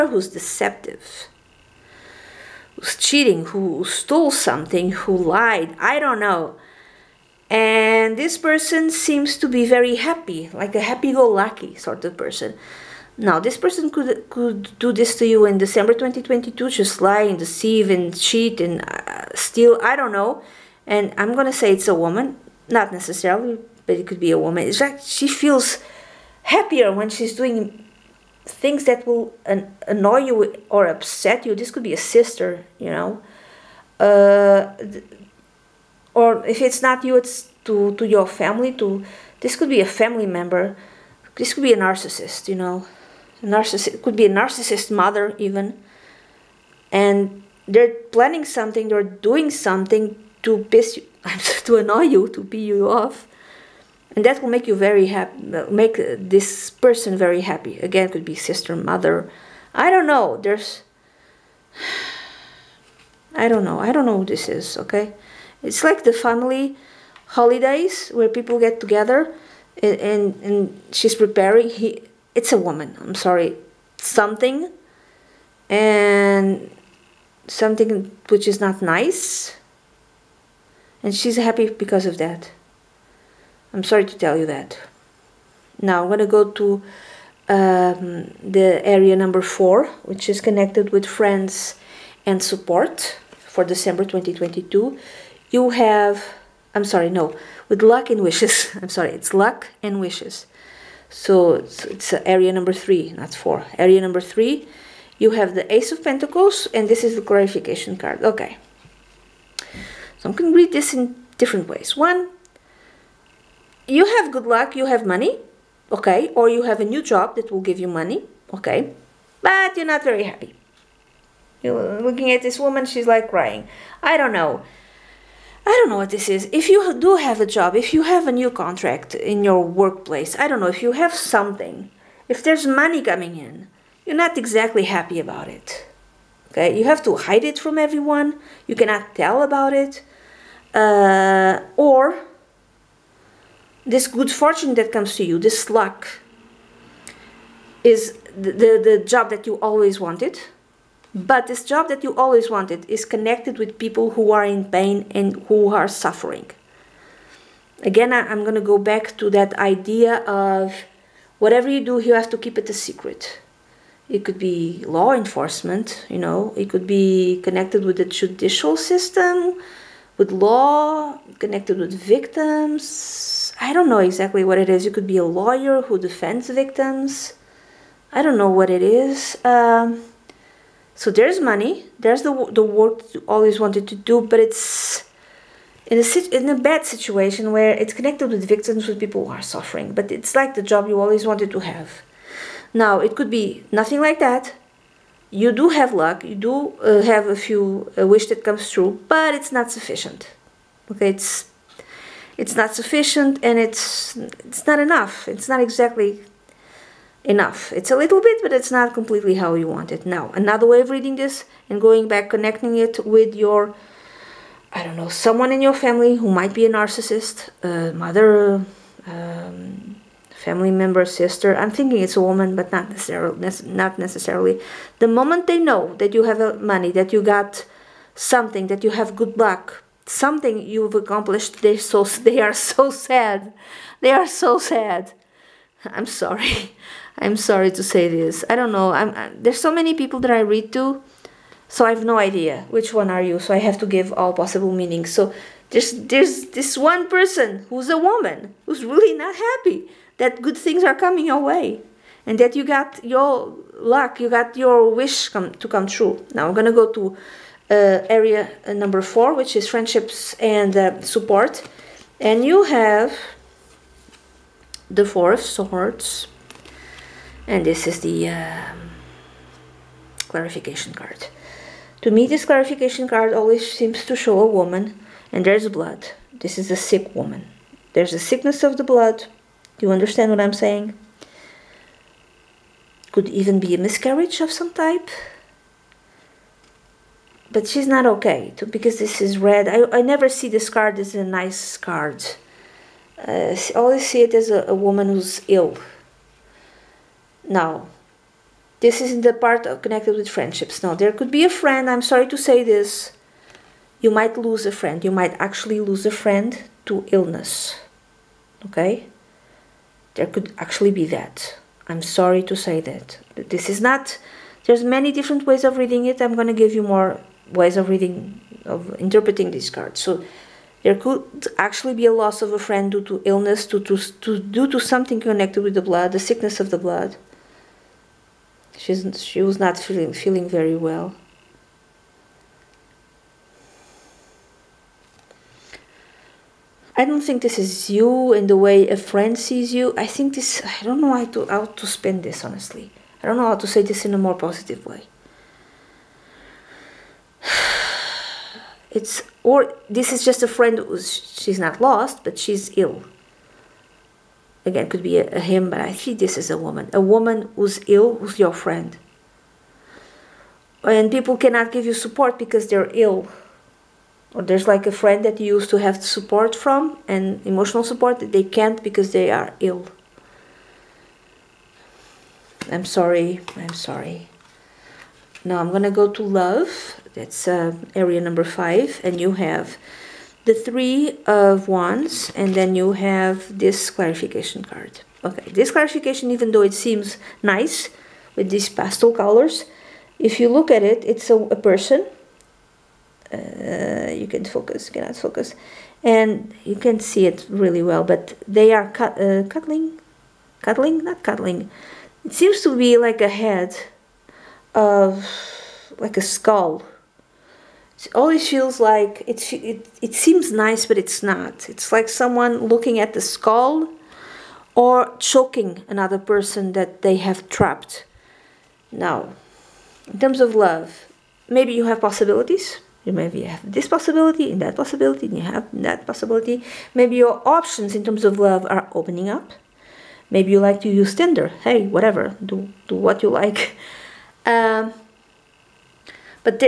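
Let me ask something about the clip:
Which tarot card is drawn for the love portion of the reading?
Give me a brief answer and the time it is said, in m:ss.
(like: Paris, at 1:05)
Three of Wands, at 6:20.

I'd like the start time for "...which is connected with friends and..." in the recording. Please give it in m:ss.
1:30.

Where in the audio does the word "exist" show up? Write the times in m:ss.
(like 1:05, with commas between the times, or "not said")
not said.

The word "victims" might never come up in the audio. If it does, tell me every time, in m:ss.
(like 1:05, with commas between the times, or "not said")
2:51, 2:56, 3:08.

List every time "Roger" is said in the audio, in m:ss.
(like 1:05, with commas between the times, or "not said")
not said.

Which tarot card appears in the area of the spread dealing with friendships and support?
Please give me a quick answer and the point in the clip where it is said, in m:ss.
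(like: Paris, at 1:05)
Four of Swords, at 4:25.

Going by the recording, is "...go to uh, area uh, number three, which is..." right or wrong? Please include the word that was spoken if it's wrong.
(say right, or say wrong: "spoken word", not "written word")
wrong: "four", not "three".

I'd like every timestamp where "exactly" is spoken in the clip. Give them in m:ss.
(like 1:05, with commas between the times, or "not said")
2:14, 2:53, 3:25.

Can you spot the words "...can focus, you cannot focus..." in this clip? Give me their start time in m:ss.
6:34.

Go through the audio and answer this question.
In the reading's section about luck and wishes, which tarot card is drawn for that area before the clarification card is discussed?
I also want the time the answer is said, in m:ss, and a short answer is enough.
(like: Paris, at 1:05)
Ace of Pentacles, at 1:45.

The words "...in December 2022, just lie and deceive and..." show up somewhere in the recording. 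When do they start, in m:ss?
0:15.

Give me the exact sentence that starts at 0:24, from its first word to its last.
It's like she feels happier when she's doing things that will an- annoy you or upset you.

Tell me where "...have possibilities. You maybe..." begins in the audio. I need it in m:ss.
7:01.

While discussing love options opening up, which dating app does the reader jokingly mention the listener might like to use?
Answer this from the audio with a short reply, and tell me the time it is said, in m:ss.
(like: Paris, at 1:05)
Tinder, at 7:11.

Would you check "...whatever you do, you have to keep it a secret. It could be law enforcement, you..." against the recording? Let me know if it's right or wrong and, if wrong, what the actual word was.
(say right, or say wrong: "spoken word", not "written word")
right.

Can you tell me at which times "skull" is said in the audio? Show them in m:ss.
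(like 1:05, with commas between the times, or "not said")
6:46, 6:53.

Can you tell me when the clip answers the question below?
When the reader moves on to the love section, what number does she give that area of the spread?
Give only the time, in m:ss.
6:18.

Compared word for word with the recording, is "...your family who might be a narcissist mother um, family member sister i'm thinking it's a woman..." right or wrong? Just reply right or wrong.
right.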